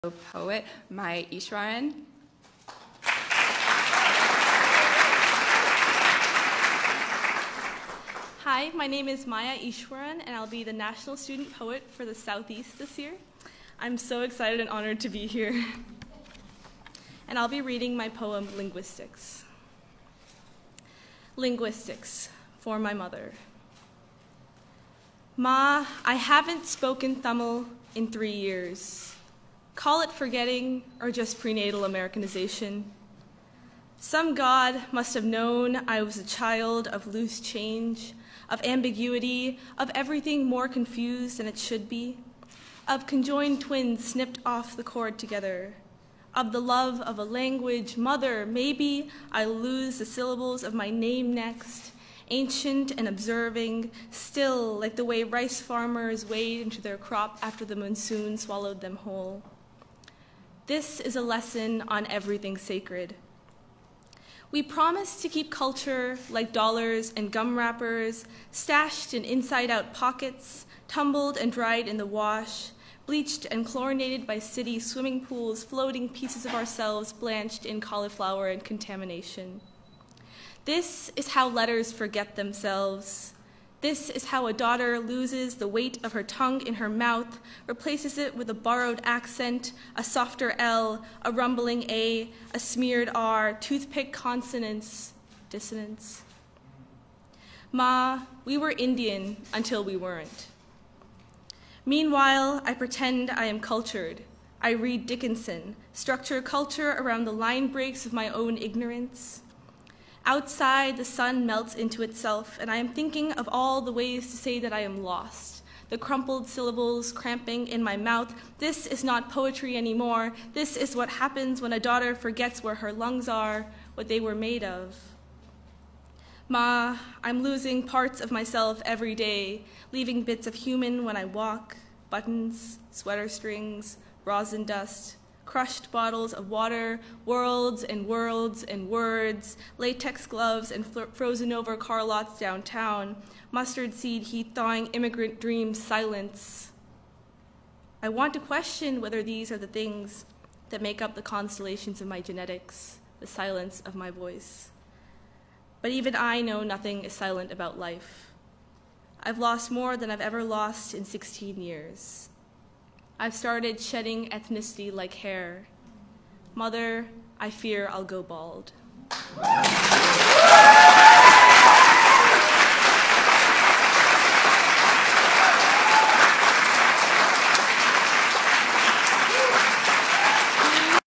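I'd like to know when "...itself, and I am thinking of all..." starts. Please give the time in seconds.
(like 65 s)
112 s.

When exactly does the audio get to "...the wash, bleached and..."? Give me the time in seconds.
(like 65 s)
71 s.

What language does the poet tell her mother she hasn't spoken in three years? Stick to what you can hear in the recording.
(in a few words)
Tamil.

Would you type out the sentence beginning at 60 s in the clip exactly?
This is a lesson on everything sacred.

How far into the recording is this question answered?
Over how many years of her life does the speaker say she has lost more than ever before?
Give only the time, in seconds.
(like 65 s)
161 s.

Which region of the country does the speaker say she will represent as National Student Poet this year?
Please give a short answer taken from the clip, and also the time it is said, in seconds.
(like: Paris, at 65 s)
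Southeast, at 12 s.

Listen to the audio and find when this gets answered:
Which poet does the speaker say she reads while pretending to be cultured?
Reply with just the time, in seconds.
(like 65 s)
105 s.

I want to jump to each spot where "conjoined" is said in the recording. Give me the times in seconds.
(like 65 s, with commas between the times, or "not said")
43 s.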